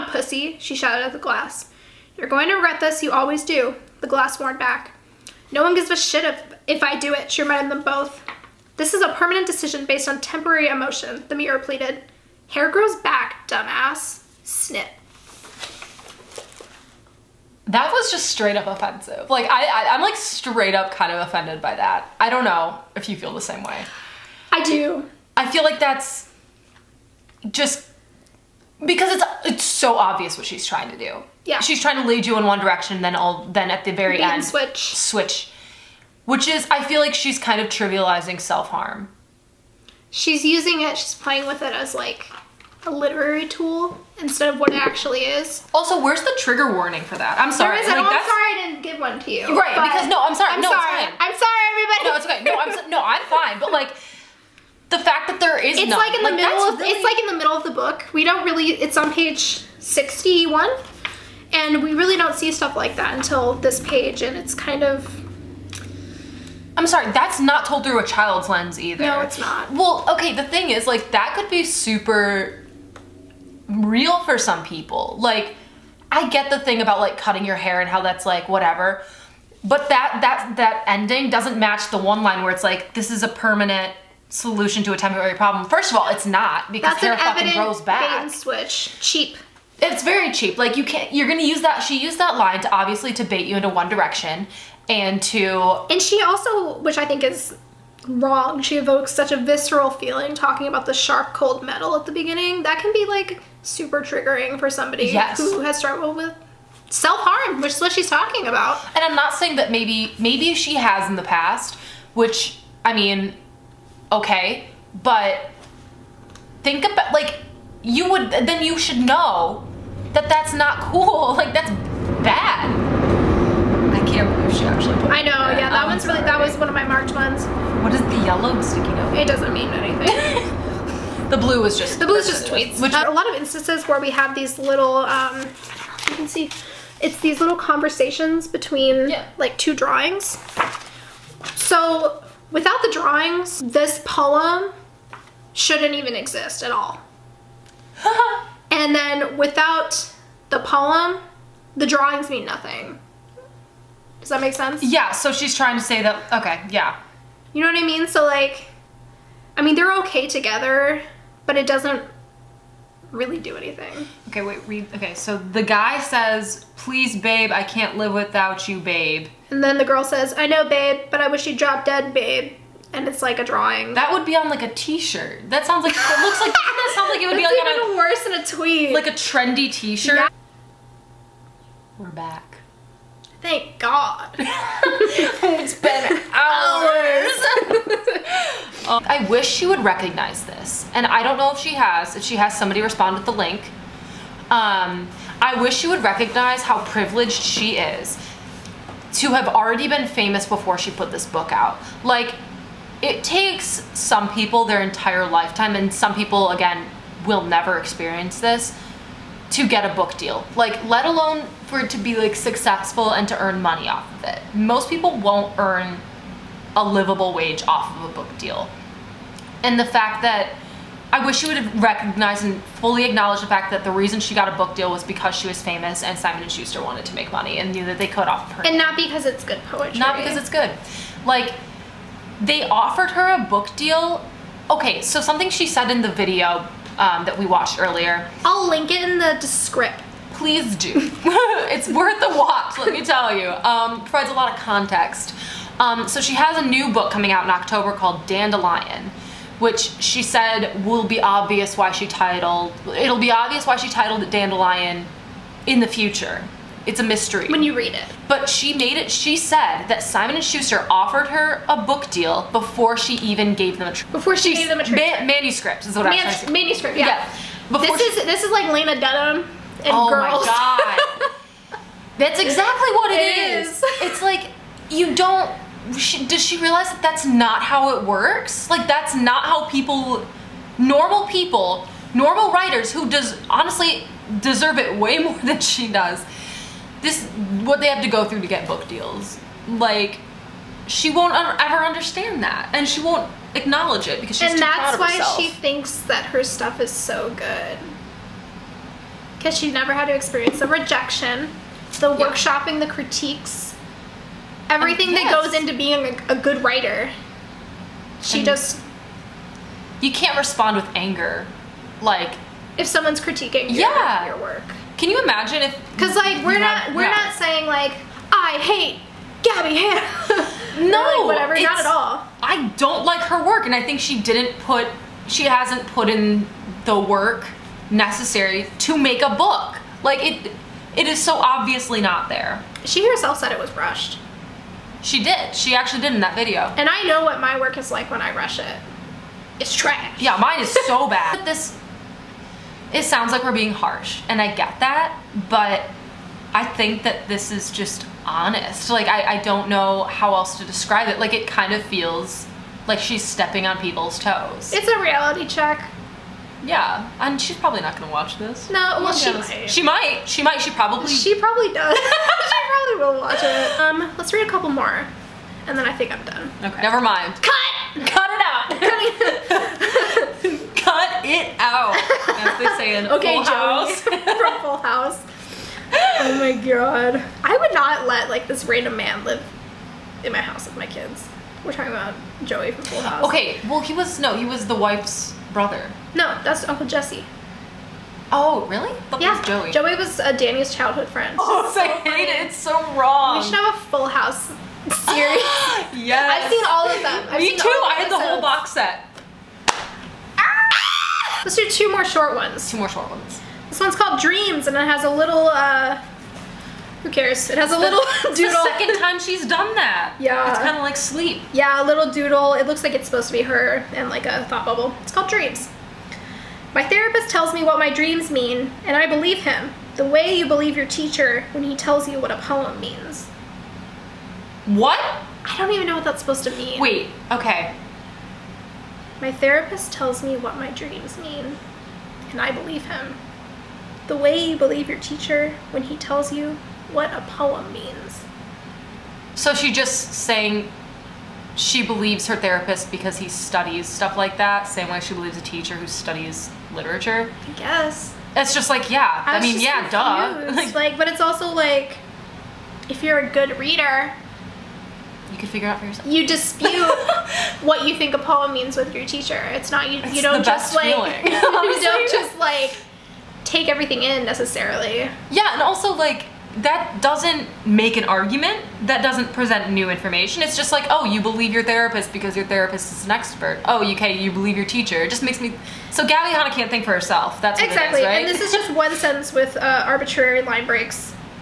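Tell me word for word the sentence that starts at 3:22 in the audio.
Like, it takes some people their entire lifetime, and some people, again, will never experience this, to get a book deal.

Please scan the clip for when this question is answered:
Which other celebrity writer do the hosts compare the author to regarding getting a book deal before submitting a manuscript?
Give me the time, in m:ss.
4:28.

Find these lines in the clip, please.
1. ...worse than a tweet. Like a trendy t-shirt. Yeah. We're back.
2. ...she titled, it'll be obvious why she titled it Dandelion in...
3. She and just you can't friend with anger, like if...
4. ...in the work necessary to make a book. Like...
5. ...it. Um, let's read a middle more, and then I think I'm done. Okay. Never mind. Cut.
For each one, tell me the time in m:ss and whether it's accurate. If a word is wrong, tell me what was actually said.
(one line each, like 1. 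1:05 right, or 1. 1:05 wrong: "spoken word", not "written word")
1. 2:57 right
2. 4:11 right
3. 5:08 wrong: "respond", not "friend"
4. 5:26 right
5. 6:03 wrong: "couple", not "middle".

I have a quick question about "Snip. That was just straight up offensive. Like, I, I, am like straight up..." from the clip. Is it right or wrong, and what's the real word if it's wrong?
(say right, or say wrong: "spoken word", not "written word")
right.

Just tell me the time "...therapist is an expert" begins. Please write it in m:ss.
7:52.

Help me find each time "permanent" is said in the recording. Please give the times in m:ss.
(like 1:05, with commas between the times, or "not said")
0:09, 1:23.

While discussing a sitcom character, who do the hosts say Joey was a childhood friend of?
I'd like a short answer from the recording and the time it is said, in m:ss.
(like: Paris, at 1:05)
Danny, at 6:30.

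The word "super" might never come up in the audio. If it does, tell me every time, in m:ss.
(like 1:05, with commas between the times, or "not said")
1:11, 1:43.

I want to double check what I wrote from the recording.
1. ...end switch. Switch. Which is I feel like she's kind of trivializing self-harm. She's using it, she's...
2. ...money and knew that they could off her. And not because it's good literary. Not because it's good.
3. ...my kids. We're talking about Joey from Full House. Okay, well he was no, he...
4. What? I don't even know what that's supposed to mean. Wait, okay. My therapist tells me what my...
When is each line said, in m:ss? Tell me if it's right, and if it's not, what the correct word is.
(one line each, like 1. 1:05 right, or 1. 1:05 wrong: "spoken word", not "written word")
1. 0:34 right
2. 3:47 wrong: "poetry", not "literary"
3. 6:20 right
4. 7:04 right.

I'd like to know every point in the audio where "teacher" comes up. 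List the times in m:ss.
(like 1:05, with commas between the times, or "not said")
7:00, 7:14, 7:25, 7:39, 7:54.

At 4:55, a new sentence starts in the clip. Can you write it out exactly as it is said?
And that's why she thinks that her stuff is so good because she never had to experience the rejection, the yeah.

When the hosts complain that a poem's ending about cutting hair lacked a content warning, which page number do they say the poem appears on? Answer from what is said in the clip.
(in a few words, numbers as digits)
61.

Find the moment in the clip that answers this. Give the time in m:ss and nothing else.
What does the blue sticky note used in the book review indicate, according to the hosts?
2:12.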